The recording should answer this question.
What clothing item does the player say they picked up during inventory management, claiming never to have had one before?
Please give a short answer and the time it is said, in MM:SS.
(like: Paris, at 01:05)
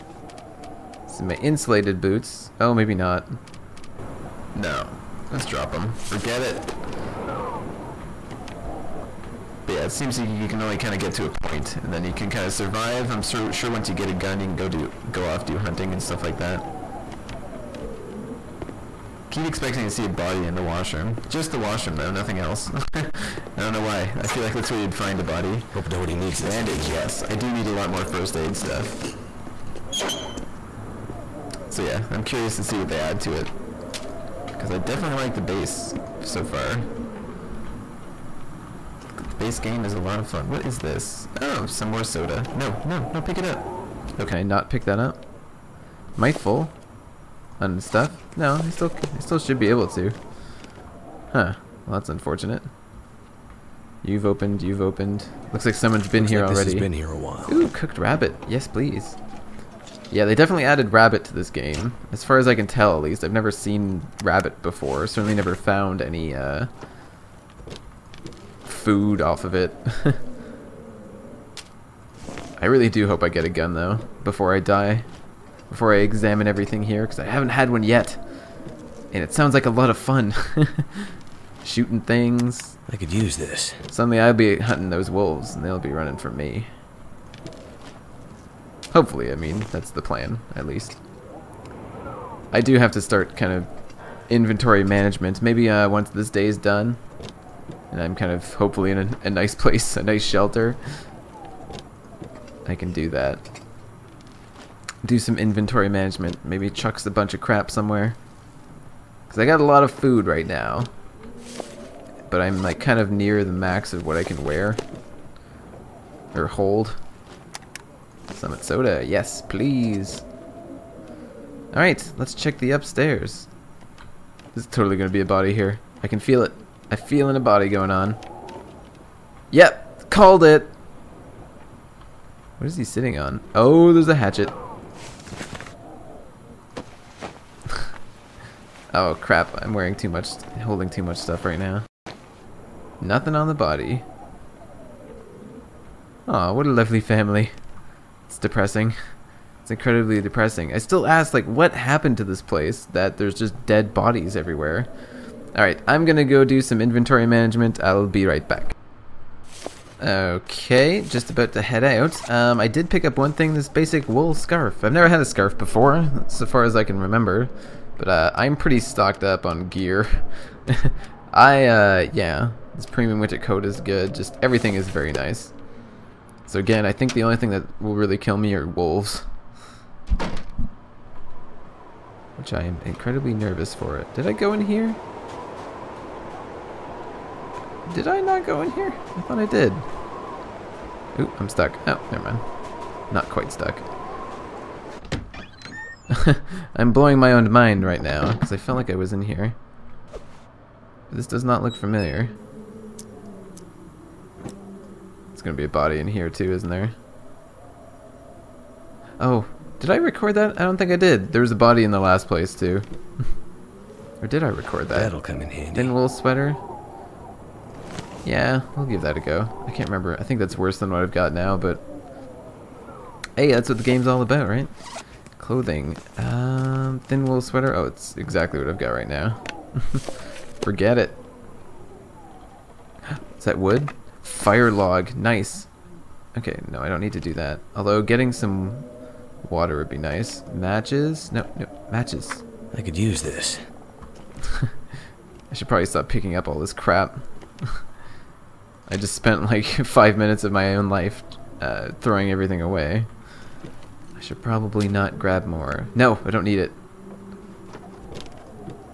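Basic wool scarf, at 02:43.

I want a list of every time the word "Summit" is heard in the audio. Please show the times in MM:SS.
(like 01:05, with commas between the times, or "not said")
01:58.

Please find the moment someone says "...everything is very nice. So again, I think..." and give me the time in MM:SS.
02:54.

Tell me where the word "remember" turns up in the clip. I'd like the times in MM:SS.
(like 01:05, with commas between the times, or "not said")
02:46, 03:39.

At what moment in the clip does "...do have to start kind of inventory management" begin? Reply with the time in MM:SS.
01:32.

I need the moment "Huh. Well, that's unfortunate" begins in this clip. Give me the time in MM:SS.
00:51.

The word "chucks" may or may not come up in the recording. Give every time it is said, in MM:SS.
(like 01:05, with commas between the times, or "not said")
01:46.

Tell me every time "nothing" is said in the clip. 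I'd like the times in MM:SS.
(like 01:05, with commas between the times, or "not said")
00:22, 02:23.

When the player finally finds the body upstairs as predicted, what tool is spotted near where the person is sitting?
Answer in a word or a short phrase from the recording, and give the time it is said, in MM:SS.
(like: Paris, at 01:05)
Hatchet, at 02:14.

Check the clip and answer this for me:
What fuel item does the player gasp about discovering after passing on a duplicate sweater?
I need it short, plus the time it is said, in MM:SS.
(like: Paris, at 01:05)
Fire log, at 03:54.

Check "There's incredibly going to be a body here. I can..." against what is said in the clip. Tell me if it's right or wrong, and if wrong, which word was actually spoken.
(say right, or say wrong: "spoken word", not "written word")
wrong: "totally", not "incredibly".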